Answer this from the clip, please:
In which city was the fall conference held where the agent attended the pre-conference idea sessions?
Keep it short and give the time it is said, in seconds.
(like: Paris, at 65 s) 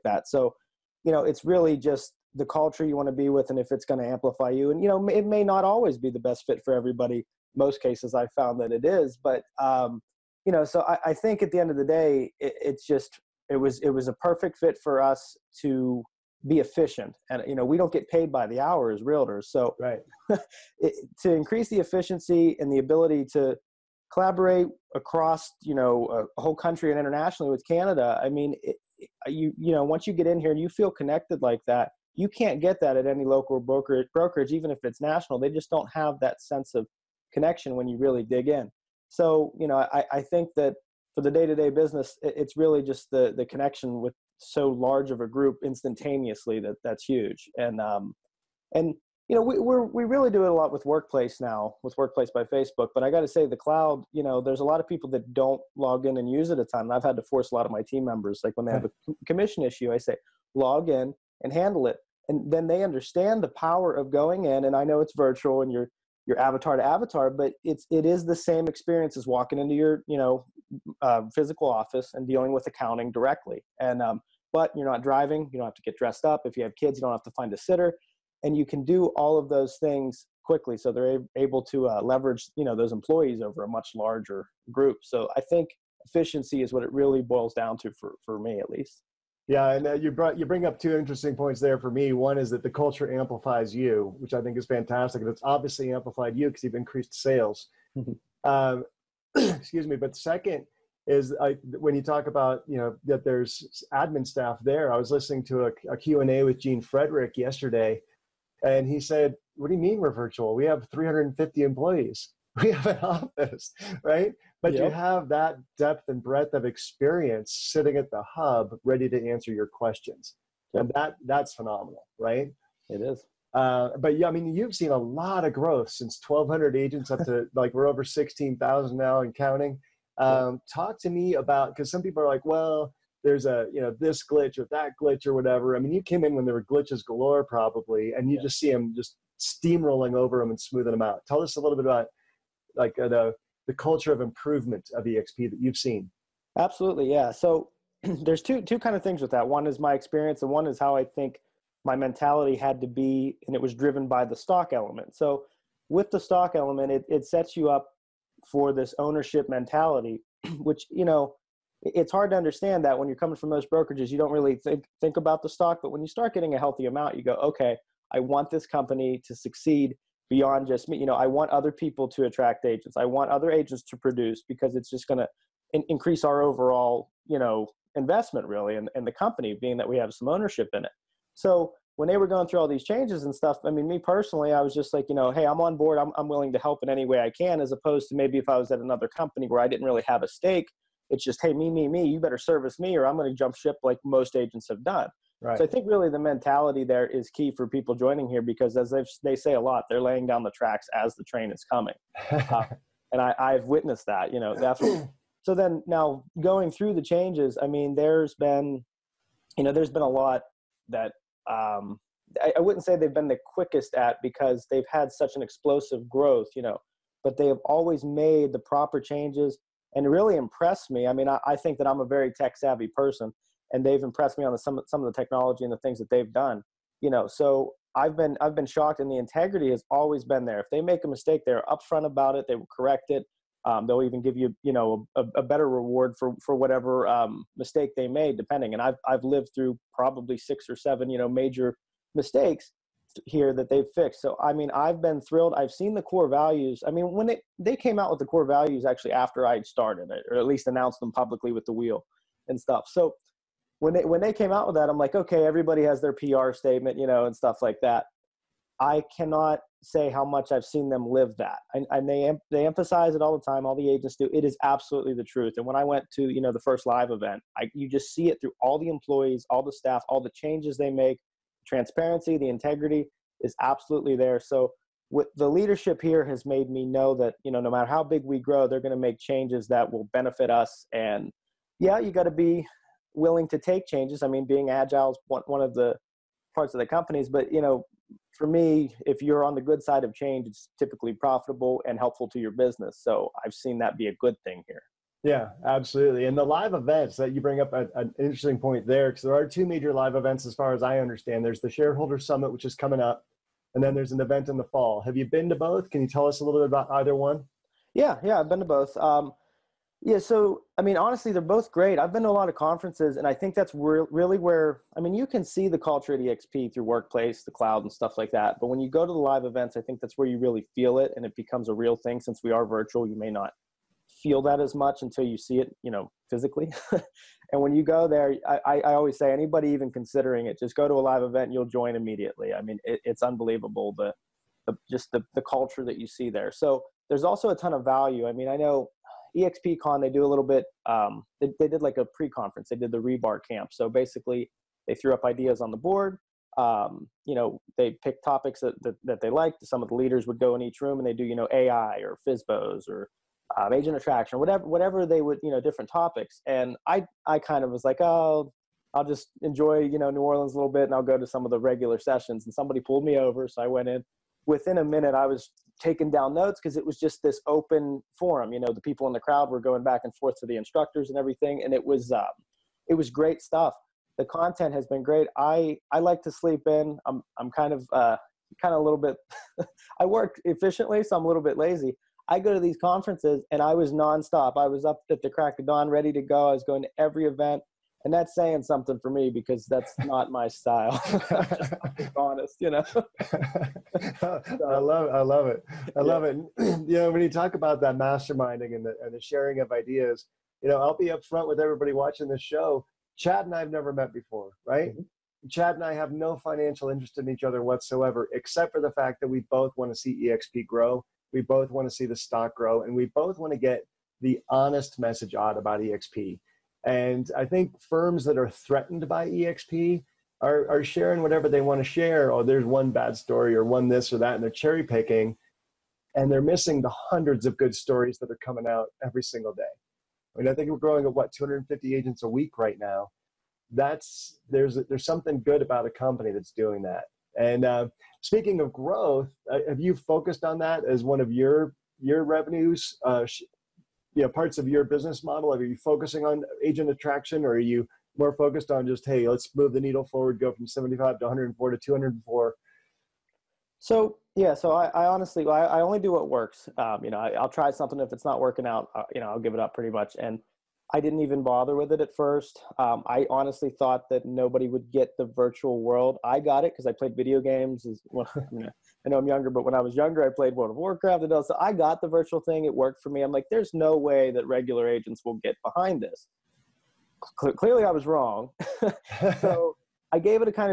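New Orleans, at 360 s.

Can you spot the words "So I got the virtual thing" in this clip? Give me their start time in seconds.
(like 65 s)
471 s.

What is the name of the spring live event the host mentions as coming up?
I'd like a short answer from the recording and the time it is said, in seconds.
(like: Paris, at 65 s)
Shareholder Summit, at 301 s.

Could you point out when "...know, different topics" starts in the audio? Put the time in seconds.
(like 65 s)
355 s.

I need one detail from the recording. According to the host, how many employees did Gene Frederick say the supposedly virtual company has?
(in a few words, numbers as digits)
350.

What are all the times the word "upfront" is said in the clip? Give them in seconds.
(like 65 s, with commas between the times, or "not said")
231 s, 401 s.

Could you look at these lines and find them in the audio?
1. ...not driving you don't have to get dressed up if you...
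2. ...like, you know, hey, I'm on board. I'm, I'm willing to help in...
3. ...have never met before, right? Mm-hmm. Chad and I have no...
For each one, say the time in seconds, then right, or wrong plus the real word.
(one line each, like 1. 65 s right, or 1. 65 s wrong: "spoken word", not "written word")
1. 74 s right
2. 184 s right
3. 403 s right.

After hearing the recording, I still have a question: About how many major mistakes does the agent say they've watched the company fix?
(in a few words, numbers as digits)
6 or 7.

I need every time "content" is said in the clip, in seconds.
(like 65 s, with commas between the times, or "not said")
374 s.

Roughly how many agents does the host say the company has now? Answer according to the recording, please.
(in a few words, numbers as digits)
16,000.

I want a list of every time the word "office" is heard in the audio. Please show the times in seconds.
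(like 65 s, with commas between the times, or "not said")
71 s, 112 s.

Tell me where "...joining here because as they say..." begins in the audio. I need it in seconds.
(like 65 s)
197 s.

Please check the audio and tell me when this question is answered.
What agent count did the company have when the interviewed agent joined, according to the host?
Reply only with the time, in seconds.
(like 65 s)
126 s.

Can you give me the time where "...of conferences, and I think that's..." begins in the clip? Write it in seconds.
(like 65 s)
312 s.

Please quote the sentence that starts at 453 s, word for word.
So yeah, so I, I honestly I, I, only do what works.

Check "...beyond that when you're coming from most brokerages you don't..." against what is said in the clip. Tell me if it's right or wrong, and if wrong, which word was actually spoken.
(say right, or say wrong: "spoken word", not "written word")
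wrong: "understand", not "beyond".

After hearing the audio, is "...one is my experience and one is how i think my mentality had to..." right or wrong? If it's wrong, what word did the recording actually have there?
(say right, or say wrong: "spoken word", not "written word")
right.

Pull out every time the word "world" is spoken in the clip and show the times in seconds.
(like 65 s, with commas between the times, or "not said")
465 s, 470 s.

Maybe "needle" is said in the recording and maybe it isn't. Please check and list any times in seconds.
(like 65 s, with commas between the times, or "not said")
449 s.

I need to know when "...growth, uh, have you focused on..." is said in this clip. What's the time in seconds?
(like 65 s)
438 s.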